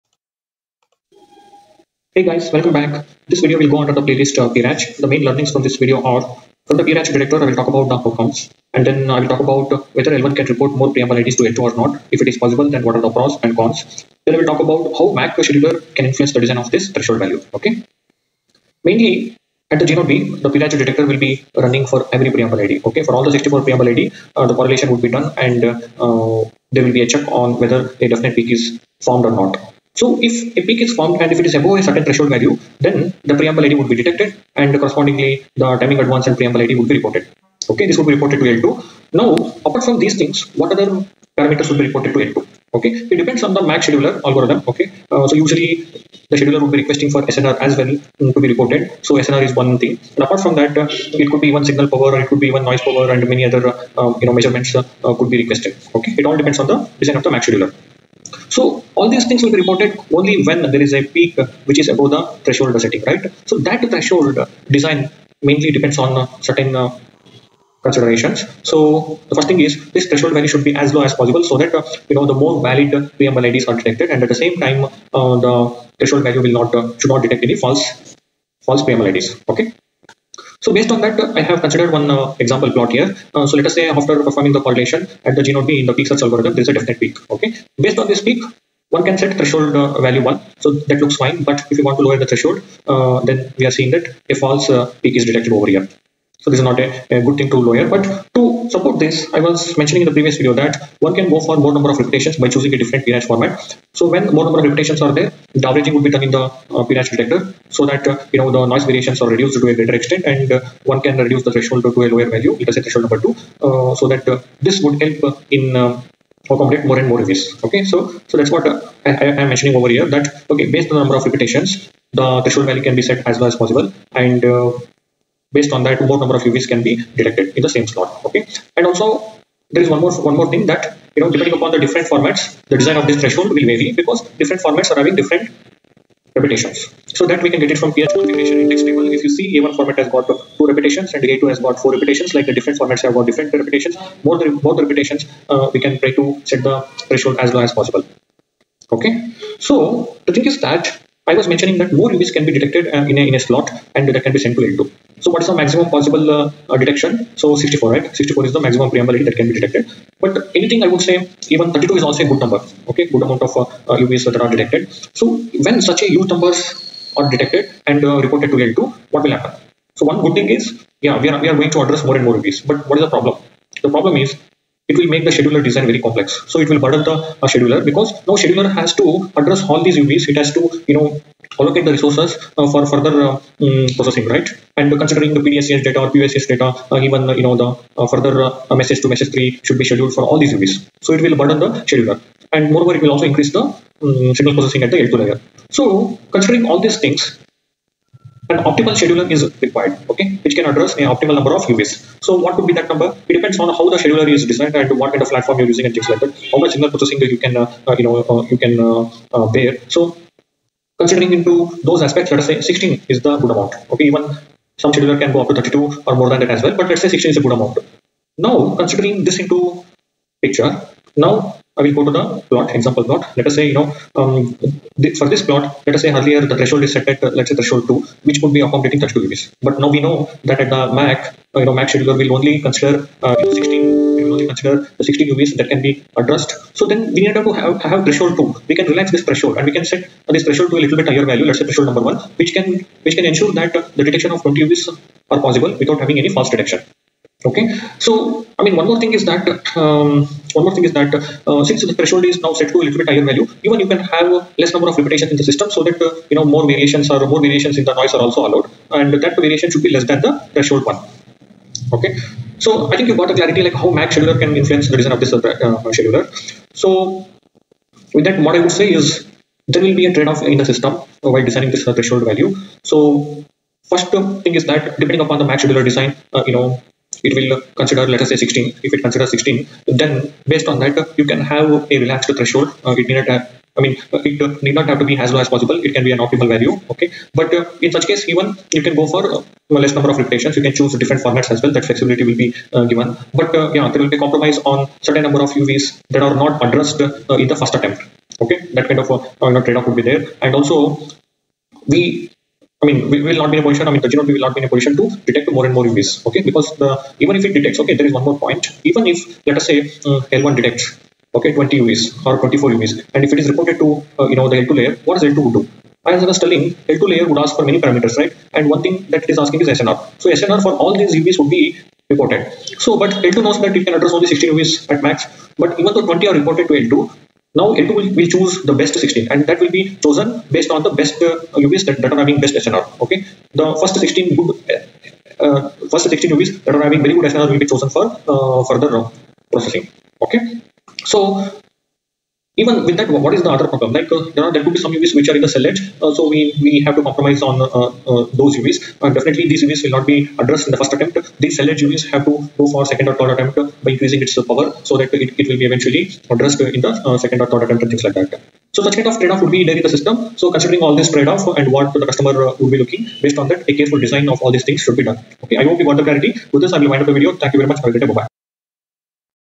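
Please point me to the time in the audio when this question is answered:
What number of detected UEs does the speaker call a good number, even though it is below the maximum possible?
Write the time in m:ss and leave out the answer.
2:41.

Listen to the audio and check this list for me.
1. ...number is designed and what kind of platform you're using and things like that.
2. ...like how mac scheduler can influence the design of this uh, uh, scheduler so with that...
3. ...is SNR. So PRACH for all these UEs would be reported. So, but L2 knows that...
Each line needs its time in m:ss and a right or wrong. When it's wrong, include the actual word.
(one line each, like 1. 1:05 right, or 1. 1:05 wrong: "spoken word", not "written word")
1. 3:24 wrong: "scheduler", not "number"
2. 4:23 right
3. 5:19 wrong: "SNR", not "PRACH".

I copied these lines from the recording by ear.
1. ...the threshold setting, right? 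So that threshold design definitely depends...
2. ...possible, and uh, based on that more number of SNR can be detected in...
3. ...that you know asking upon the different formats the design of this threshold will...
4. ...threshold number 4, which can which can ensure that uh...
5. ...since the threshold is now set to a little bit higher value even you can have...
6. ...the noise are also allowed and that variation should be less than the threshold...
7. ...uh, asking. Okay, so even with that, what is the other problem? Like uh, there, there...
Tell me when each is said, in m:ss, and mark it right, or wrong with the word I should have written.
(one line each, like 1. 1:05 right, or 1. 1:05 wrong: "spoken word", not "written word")
1. 1:02 wrong: "mainly", not "definitely"
2. 2:03 wrong: "UEs", not "SNR"
3. 2:10 wrong: "depending", not "asking"
4. 4:01 wrong: "1", not "4"
5. 4:11 right
6. 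4:17 right
7. 5:38 wrong: "processing", not "asking".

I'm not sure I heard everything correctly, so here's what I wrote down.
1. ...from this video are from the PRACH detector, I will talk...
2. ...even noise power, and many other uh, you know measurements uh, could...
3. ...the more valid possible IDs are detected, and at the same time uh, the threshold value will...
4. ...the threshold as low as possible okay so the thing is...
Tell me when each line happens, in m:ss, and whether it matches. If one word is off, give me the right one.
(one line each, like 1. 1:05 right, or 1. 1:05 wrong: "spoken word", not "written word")
1. 0:05 right
2. 0:52 right
3. 1:12 wrong: "preamble", not "possible"
4. 2:26 right.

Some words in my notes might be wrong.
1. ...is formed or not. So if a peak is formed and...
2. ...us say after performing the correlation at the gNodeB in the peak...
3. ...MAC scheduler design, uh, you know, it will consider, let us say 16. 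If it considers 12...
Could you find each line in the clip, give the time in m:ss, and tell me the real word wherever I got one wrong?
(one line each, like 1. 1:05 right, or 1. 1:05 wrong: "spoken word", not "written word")
1. 0:28 right
2. 1:23 right
3. 4:35 wrong: "16", not "12".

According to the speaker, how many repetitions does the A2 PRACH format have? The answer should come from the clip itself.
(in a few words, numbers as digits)
4.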